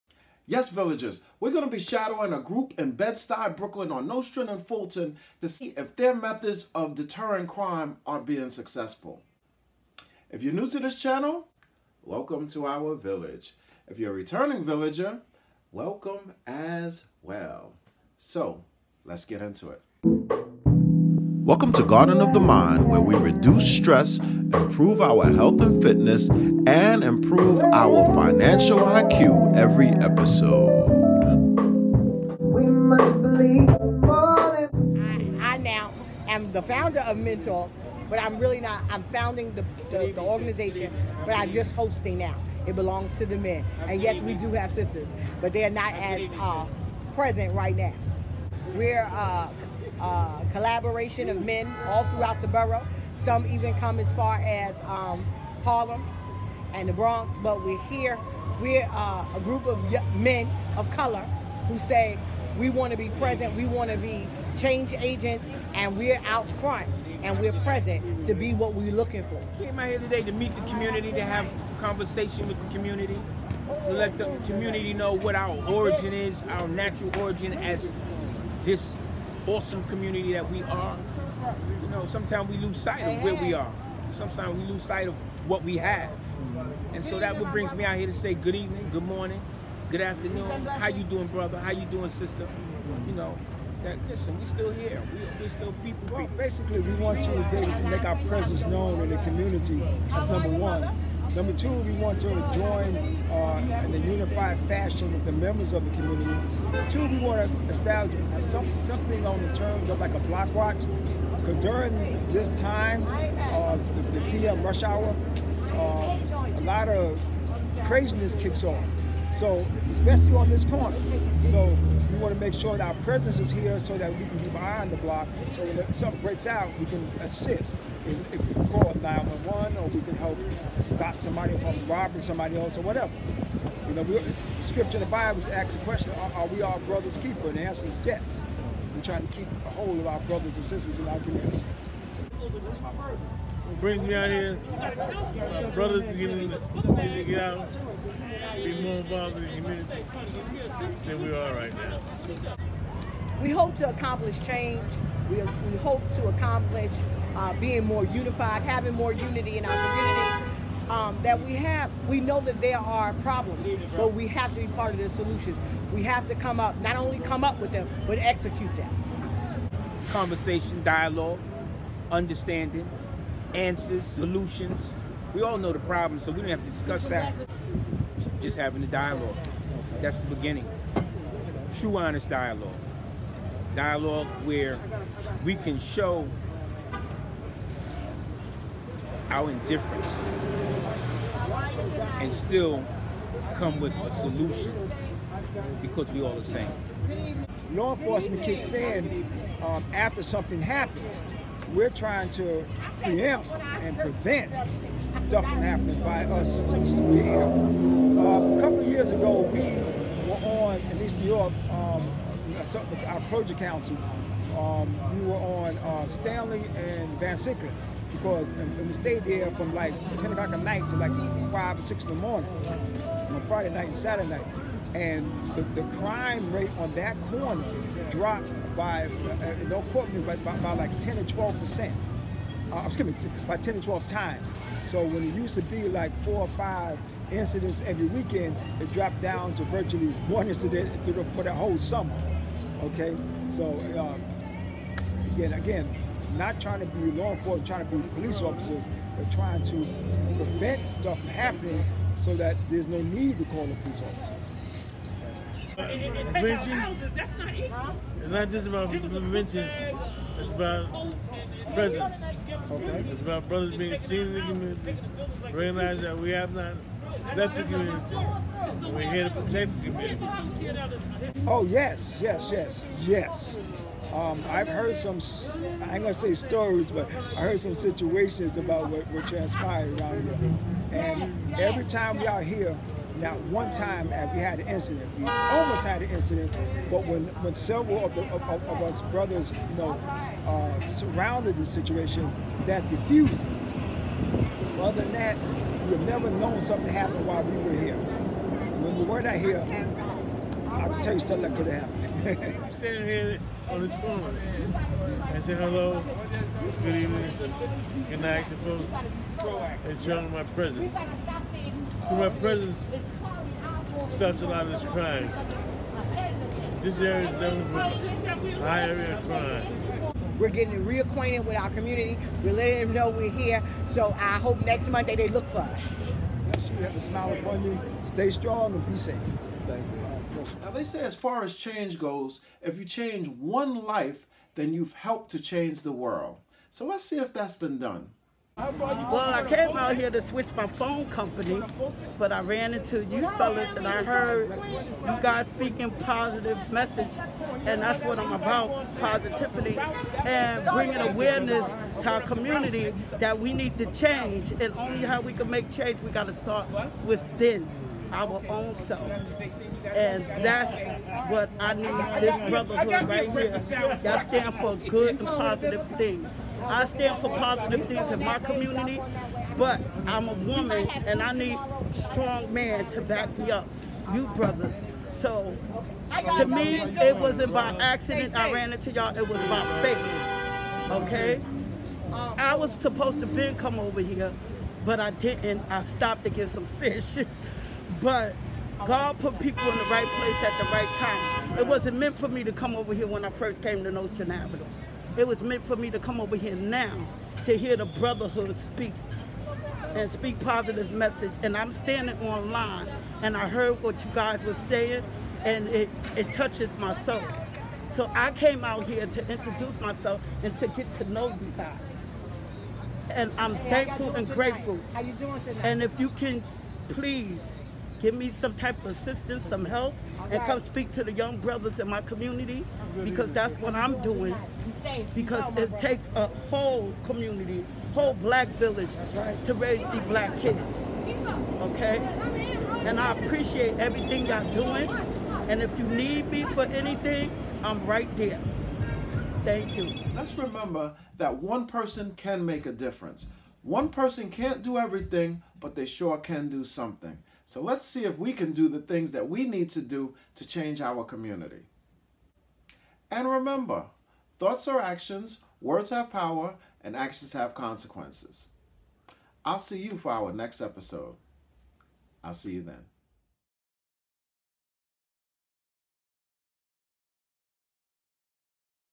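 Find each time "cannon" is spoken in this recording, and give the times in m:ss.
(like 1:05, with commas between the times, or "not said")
not said.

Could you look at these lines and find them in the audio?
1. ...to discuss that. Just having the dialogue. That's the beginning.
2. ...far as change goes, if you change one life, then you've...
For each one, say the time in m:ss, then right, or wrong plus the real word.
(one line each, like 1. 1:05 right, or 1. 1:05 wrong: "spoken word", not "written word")
1. 2:56 right
2. 5:31 right.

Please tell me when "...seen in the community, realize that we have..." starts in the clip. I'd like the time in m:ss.
4:24.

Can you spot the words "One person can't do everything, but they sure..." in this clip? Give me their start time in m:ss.
7:23.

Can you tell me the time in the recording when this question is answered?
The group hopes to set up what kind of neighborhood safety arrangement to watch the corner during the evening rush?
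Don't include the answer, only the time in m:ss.
1:50.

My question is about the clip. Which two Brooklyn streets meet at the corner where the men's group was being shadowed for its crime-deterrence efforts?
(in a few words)
Nostrand and Fulton.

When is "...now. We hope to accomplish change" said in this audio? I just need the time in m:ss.
2:31.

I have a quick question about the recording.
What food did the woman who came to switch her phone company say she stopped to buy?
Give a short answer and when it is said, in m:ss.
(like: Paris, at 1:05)
Fish, at 6:26.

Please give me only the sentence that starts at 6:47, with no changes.
So I came out here to introduce myself and to get to know you guys.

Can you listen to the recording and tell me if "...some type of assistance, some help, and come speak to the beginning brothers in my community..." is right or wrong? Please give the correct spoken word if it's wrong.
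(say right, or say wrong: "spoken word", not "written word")
wrong: "young", not "beginning".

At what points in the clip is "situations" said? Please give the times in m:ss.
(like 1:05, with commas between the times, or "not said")
4:37, 4:51.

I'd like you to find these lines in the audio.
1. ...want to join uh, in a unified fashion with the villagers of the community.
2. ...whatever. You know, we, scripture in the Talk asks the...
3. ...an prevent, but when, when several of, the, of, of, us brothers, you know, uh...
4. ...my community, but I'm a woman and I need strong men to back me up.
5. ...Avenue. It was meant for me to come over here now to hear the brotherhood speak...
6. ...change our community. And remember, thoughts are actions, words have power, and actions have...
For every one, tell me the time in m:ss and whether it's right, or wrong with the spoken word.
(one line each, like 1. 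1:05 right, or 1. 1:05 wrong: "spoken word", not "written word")
1. 1:41 wrong: "members", not "villagers"
2. 2:12 wrong: "Bible", not "Talk"
3. 4:46 wrong: "incident", not "prevent"
4. 6:08 right
5. 6:34 right
6. 7:30 right.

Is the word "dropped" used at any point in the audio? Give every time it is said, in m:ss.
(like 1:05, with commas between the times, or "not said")
3:48, 3:58.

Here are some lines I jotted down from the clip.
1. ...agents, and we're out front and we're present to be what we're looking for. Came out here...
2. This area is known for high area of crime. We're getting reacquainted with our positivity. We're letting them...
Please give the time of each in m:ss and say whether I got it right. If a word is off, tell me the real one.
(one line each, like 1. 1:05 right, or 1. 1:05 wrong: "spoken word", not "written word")
1. 1:04 right
2. 5:16 wrong: "community", not "positivity".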